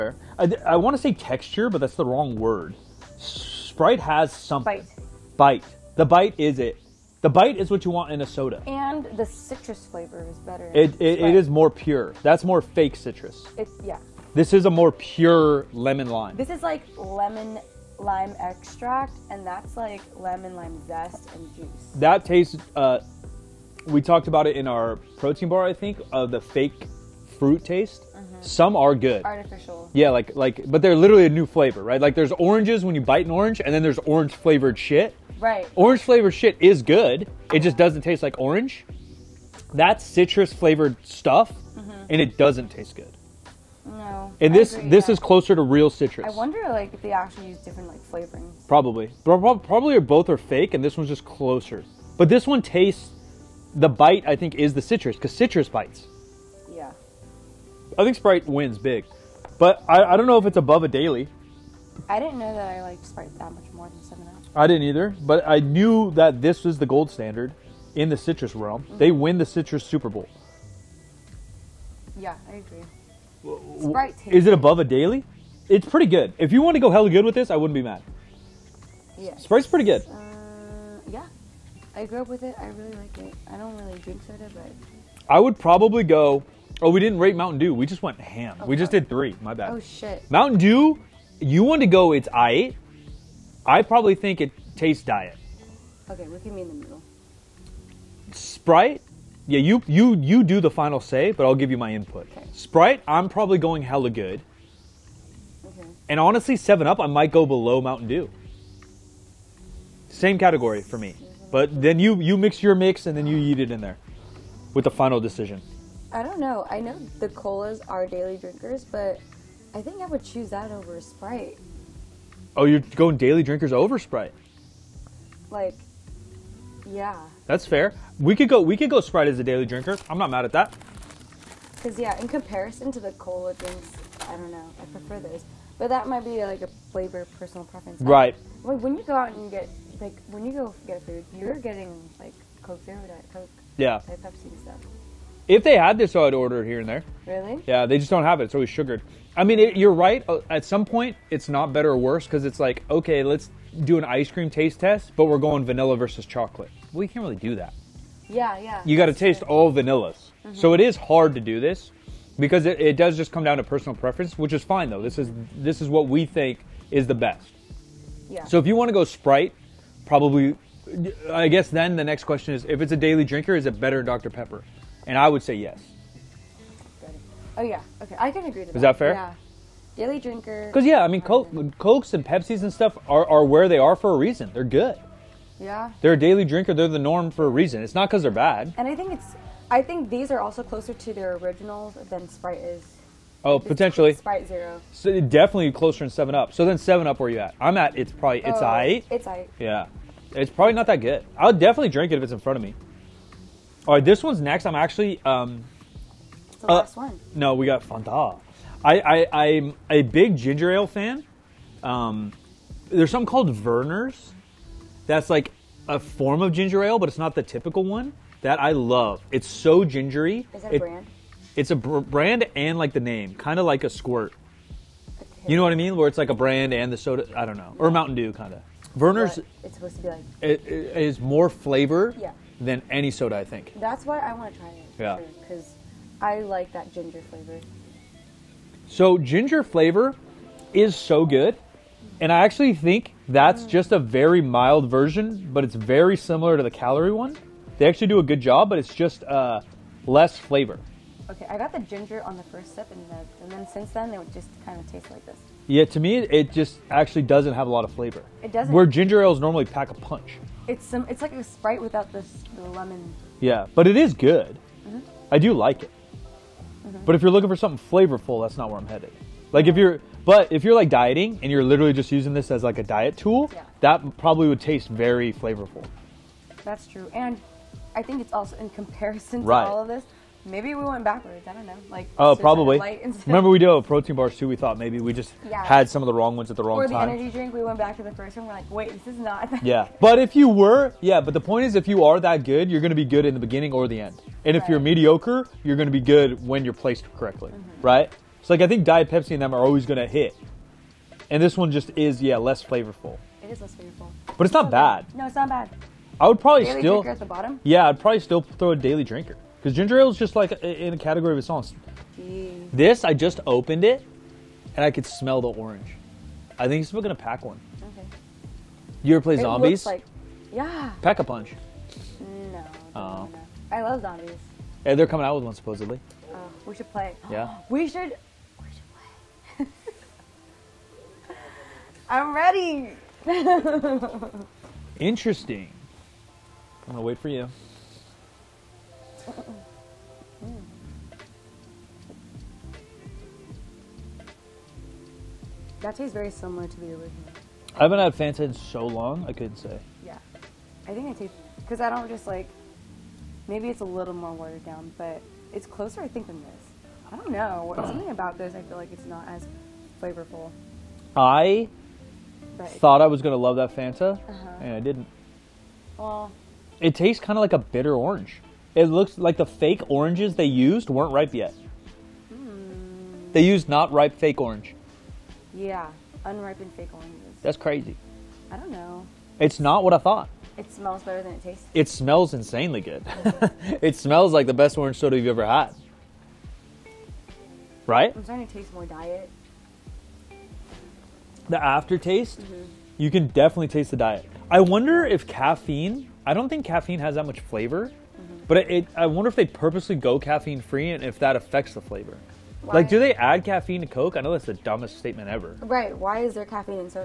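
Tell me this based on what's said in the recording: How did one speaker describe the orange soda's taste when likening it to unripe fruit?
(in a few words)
Bitter orange.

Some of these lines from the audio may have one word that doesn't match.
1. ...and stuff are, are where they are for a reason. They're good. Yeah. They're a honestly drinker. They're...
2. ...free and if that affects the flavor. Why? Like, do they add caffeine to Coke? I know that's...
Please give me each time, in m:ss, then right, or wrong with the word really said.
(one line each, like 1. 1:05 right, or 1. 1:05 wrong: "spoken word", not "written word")
1. 3:02 wrong: "daily", not "honestly"
2. 6:40 right.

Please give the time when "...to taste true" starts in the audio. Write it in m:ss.
2:39.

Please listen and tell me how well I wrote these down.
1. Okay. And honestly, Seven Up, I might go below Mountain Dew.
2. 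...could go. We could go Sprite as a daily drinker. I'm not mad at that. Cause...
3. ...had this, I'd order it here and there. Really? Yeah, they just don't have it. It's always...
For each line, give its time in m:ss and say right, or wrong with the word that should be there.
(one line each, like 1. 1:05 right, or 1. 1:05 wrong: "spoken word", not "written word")
1. 1:45 right
2. 2:08 right
3. 2:25 right.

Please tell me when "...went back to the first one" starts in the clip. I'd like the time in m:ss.
4:47.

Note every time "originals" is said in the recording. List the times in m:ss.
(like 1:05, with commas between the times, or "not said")
3:11, 5:46.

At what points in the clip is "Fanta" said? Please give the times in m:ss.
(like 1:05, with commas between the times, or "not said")
3:27, 5:48, 6:03.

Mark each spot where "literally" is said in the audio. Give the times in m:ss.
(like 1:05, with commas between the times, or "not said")
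0:30, 4:31.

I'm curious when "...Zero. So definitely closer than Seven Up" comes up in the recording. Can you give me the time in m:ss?
3:14.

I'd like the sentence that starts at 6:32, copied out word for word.
you can definitely taste the diet.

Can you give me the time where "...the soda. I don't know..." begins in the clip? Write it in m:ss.
3:46.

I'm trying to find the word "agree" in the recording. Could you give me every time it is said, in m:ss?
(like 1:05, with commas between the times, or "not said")
0:44, 1:12, 2:58.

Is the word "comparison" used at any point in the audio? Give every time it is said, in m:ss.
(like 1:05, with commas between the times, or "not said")
2:12, 4:38.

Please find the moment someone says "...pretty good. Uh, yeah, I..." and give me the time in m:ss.
1:19.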